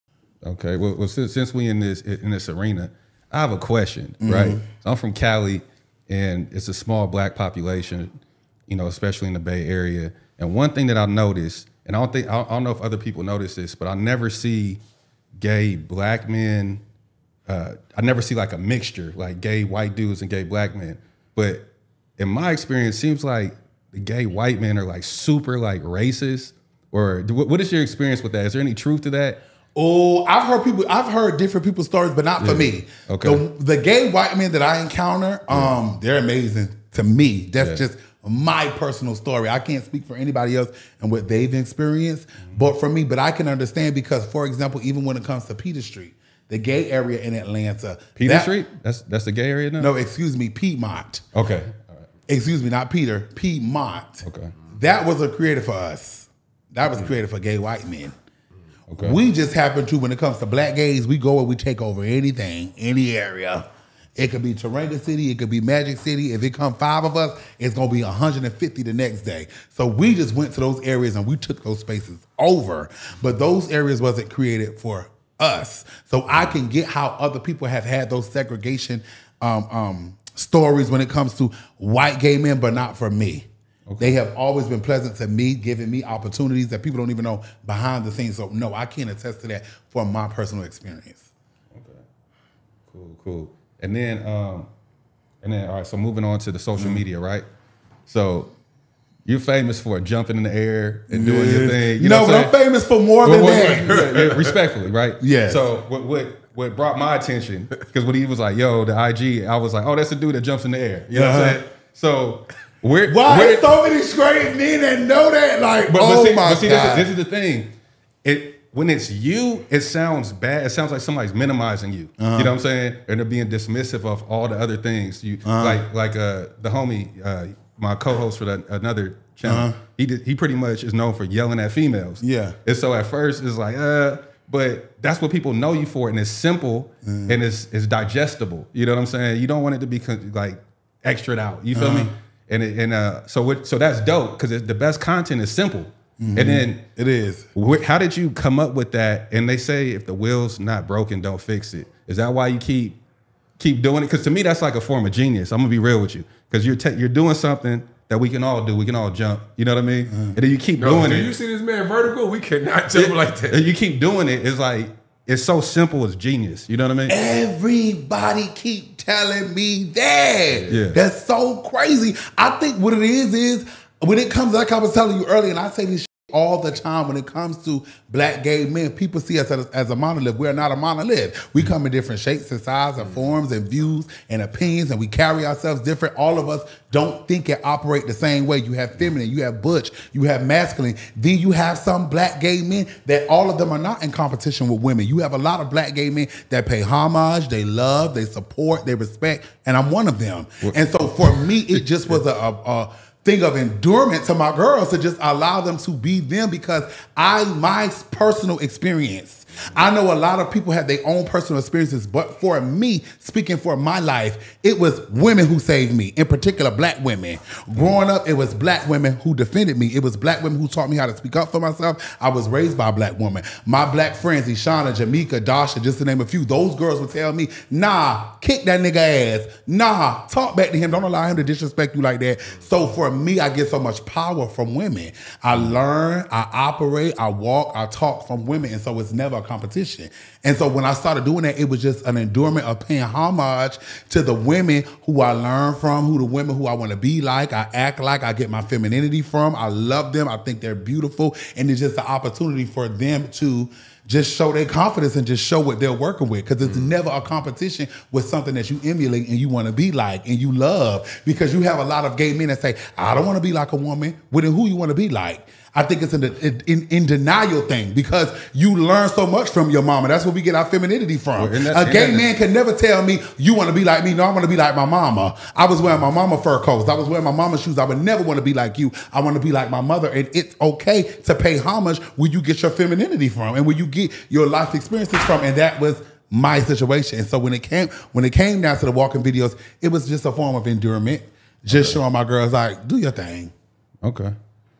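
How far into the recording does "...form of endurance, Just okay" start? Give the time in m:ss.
4:50.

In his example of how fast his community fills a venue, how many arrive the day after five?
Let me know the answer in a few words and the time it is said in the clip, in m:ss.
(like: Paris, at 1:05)
150, at 1:08.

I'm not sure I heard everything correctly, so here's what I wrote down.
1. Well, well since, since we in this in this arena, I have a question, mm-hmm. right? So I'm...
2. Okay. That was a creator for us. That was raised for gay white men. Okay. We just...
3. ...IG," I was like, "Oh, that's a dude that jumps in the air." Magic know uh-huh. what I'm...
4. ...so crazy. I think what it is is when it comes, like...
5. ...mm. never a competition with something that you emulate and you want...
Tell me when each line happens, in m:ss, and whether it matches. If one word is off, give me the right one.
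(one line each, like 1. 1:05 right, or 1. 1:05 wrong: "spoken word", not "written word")
1. 0:00 right
2. 0:54 wrong: "created", not "raised"
3. 1:49 wrong: "You", not "Magic"
4. 2:51 right
5. 4:16 right.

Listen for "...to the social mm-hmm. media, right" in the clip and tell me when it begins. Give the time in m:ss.
1:36.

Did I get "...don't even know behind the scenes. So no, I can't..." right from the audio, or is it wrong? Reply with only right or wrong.
right.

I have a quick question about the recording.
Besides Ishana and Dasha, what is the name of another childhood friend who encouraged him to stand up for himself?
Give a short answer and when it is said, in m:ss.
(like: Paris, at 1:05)
Jamika, at 3:44.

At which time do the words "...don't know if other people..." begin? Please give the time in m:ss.
0:12.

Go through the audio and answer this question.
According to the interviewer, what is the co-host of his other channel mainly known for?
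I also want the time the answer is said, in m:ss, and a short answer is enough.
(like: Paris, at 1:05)
Yelling at females, at 2:11.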